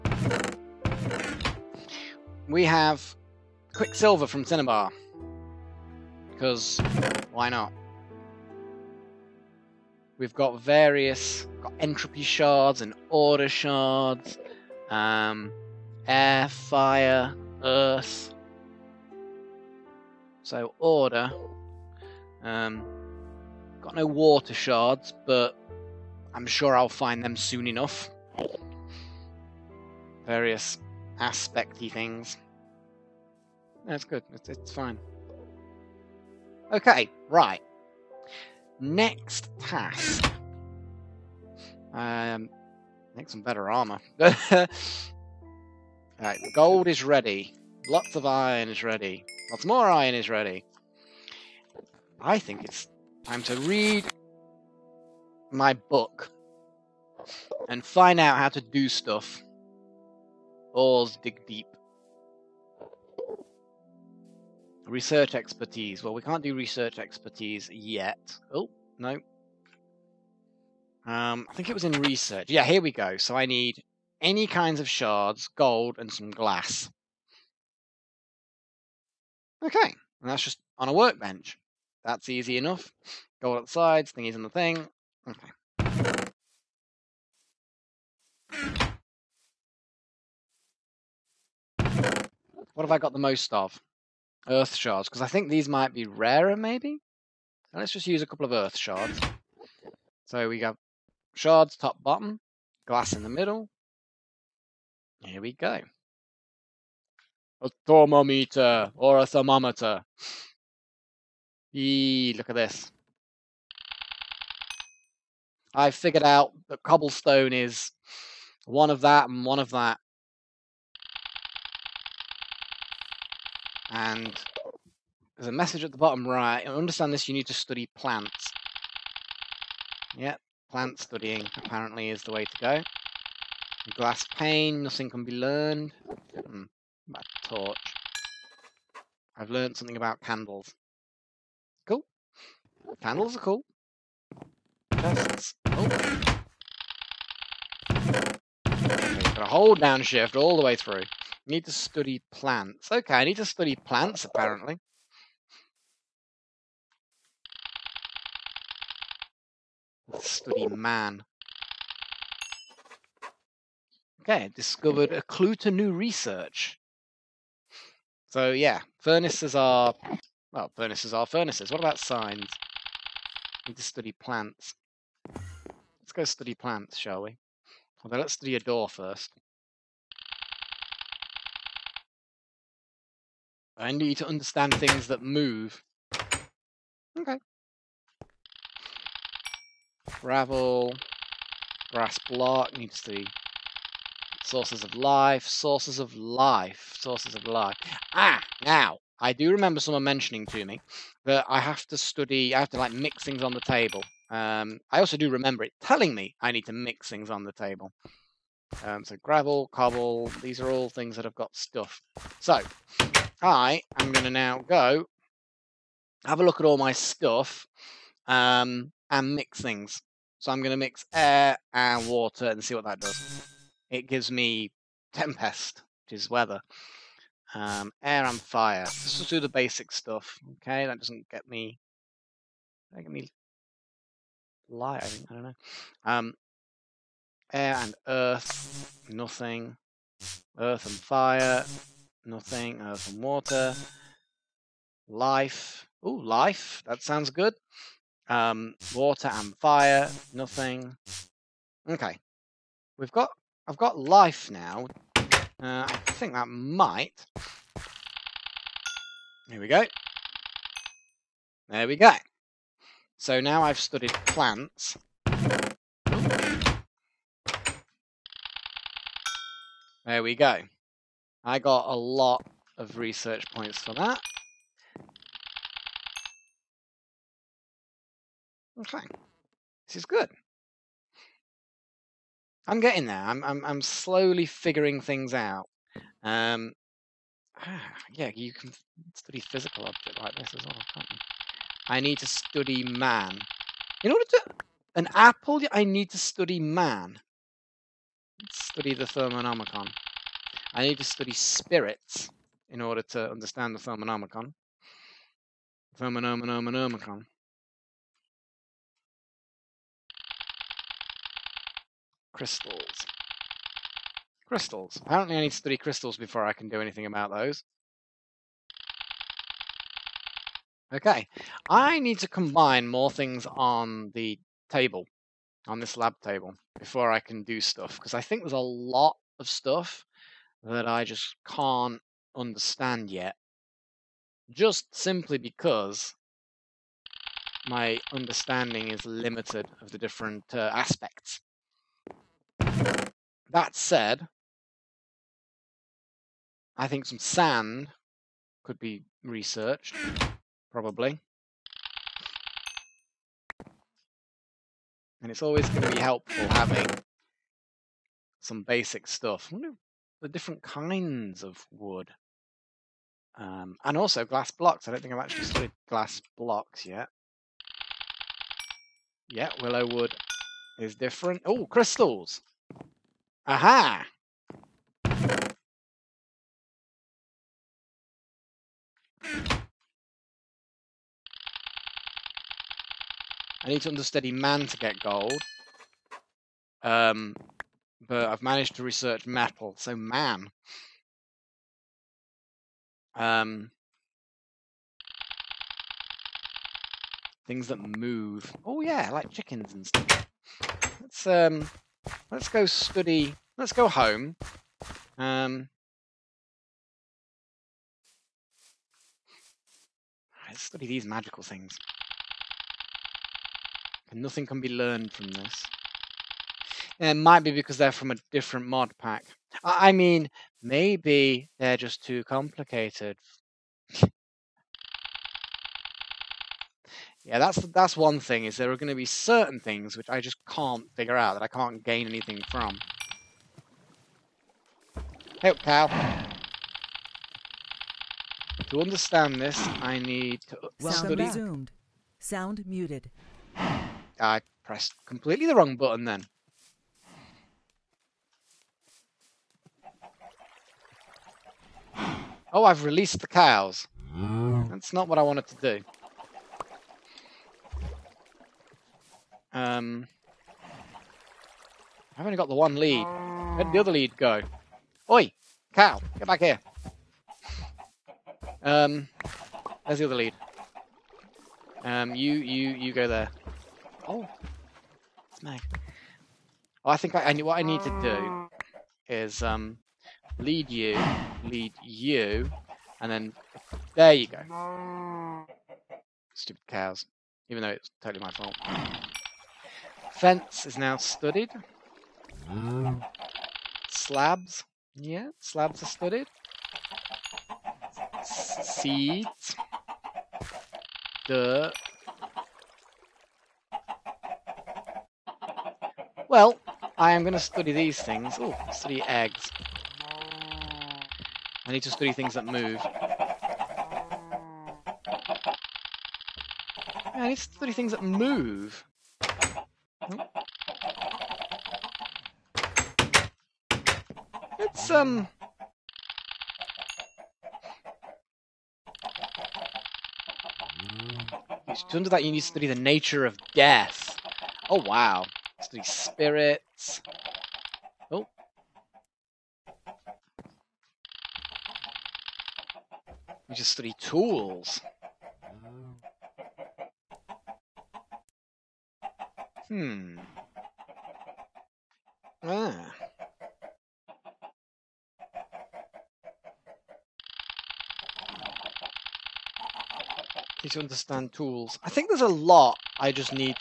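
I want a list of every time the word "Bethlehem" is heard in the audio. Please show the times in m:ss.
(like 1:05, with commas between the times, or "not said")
not said.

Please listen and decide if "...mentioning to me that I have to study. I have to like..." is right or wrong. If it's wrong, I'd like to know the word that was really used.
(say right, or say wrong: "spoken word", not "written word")
right.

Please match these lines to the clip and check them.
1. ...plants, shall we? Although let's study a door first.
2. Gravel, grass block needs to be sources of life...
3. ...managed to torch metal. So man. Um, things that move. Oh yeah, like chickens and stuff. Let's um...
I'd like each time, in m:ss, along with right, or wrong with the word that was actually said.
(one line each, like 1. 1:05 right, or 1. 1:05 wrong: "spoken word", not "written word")
1. 2:56 right
2. 3:10 right
3. 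6:28 wrong: "research", not "torch".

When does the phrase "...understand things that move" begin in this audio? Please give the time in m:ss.
3:04.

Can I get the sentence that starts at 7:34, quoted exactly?
That's not what I wanted to do.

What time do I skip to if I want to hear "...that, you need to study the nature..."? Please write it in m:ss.
8:52.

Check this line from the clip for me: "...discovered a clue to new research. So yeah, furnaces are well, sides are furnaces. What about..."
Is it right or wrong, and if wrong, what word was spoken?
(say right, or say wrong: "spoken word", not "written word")
wrong: "furnaces", not "sides".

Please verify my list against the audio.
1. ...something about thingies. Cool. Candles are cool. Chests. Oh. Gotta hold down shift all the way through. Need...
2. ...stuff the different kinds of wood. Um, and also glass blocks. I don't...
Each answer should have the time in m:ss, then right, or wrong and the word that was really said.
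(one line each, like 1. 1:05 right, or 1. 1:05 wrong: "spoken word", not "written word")
1. 2:19 wrong: "candles", not "thingies"
2. 5:59 right.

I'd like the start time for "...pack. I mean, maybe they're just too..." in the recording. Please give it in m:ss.
6:58.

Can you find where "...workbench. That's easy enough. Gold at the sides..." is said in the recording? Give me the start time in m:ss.
1:20.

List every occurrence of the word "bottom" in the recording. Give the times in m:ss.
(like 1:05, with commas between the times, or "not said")
1:42, 2:05.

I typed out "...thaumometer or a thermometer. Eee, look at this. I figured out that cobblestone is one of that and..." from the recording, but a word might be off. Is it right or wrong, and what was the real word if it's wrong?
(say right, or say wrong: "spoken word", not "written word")
right.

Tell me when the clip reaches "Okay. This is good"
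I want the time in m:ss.
4:38.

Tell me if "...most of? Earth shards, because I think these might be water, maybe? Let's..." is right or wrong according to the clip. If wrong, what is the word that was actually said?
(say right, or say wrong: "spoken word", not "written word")
wrong: "rarer", not "water".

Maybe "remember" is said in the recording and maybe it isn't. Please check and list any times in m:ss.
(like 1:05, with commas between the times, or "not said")
3:19, 3:25.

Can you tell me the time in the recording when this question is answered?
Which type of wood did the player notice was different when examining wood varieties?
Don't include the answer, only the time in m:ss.
6:09.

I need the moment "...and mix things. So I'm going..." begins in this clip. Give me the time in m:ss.
3:39.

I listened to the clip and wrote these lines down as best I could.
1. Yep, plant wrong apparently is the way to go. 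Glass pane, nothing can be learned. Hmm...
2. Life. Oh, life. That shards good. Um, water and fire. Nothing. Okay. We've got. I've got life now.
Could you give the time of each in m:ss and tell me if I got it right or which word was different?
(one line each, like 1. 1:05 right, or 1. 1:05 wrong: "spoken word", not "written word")
1. 2:10 wrong: "studying", not "wrong"
2. 4:05 wrong: "sounds", not "shards".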